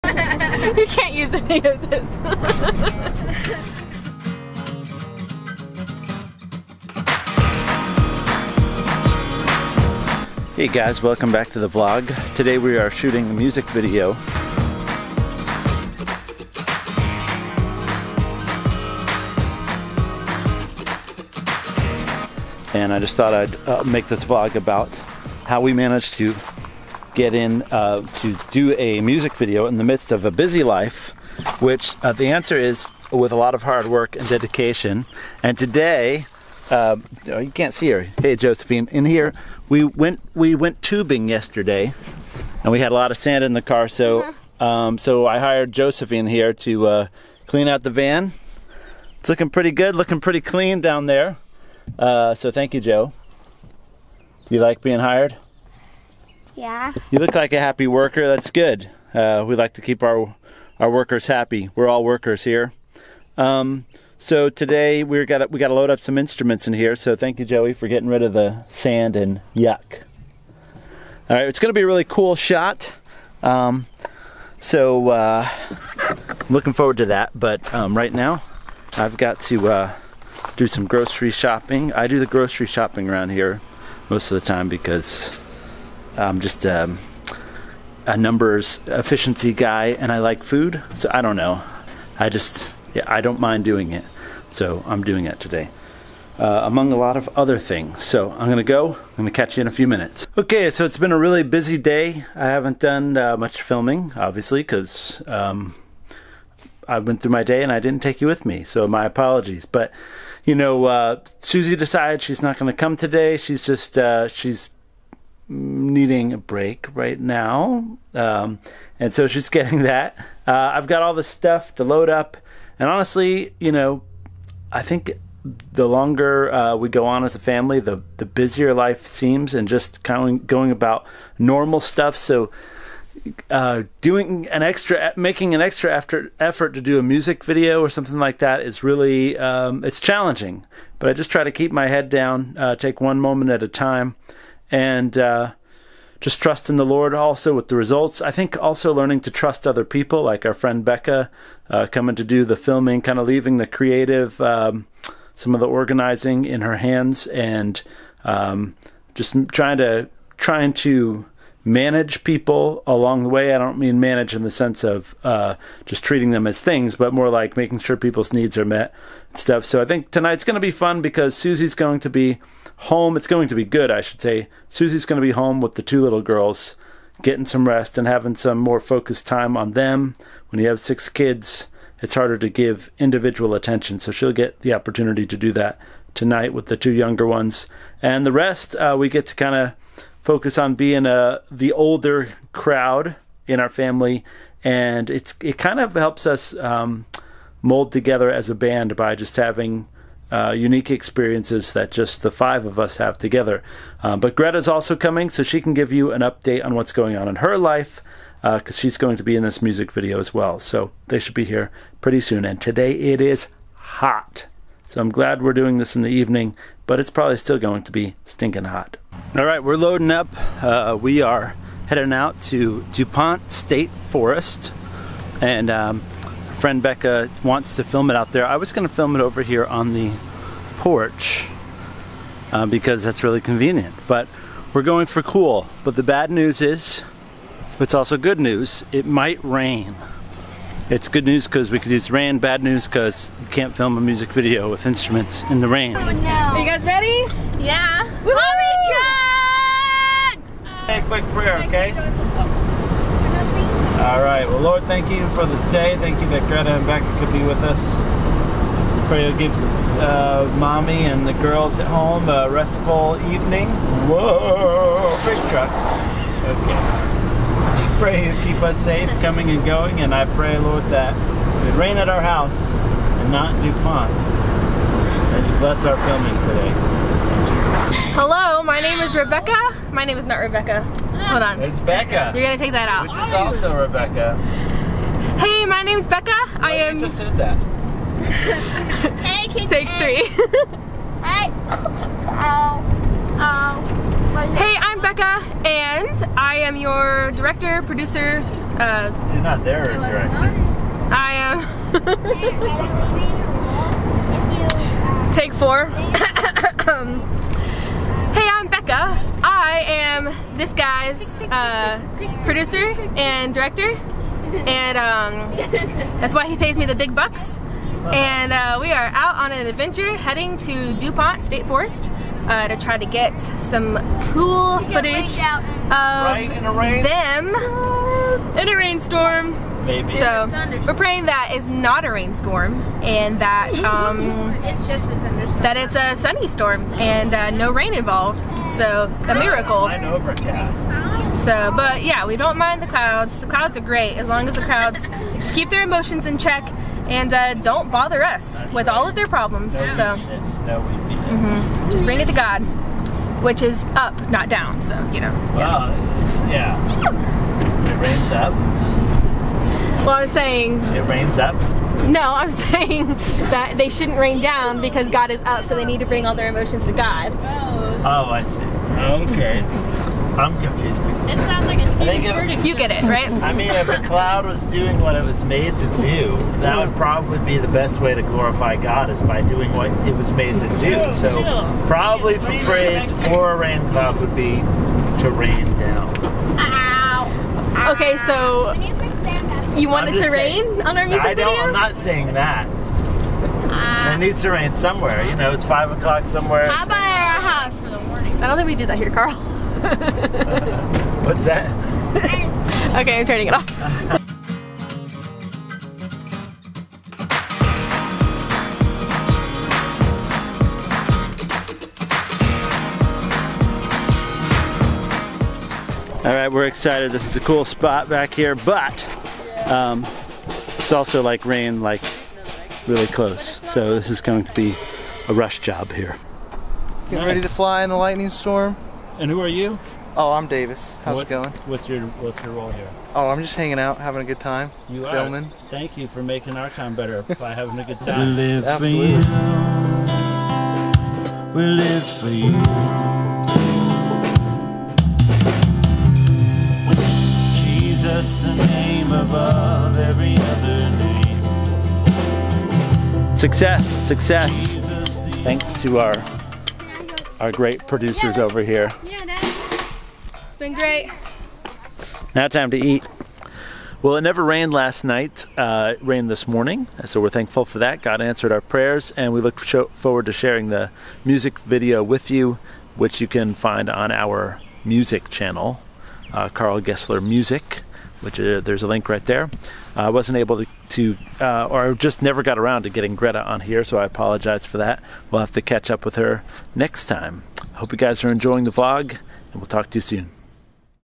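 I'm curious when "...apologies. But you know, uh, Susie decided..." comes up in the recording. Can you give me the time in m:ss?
1:49.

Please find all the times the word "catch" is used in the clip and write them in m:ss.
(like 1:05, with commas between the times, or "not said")
1:39, 8:05.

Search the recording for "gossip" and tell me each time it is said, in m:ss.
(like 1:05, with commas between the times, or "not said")
not said.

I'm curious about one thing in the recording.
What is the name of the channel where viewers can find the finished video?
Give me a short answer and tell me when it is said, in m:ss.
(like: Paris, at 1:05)
Karl Gessler Music, at 7:56.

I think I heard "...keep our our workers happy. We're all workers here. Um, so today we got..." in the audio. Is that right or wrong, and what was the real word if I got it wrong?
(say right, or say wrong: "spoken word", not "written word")
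right.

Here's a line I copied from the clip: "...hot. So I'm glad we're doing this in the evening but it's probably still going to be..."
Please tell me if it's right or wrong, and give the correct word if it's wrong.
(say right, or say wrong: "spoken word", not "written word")
right.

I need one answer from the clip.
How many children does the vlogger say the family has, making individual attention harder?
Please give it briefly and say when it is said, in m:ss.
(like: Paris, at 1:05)
6, at 3:00.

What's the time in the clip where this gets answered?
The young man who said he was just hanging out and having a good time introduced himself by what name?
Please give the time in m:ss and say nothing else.
7:10.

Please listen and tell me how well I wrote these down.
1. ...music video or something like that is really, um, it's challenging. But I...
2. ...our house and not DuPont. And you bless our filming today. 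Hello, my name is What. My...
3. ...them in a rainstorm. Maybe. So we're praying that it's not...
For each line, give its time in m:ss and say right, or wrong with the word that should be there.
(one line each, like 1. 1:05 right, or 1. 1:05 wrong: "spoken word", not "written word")
1. 2:17 right
2. 4:32 wrong: "Rebecca", not "What"
3. 5:25 right.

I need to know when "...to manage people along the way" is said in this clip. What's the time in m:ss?
2:40.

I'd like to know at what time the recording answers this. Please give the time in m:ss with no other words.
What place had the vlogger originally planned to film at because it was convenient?
3:49.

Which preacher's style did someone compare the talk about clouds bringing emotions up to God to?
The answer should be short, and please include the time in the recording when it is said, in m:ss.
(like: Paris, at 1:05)
Stephen Furtick, at 6:11.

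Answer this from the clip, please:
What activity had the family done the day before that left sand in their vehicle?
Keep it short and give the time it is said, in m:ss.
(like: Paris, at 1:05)
Tubing, at 0:40.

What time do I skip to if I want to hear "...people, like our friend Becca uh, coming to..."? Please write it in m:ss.
2:29.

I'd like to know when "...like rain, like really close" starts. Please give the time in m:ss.
7:01.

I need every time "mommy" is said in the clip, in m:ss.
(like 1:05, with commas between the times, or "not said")
4:20.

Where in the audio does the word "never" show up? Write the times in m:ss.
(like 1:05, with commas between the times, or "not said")
7:44, 8:02.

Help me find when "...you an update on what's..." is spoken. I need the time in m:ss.
3:25.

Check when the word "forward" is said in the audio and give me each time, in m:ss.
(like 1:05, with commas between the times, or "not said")
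1:16, 7:49.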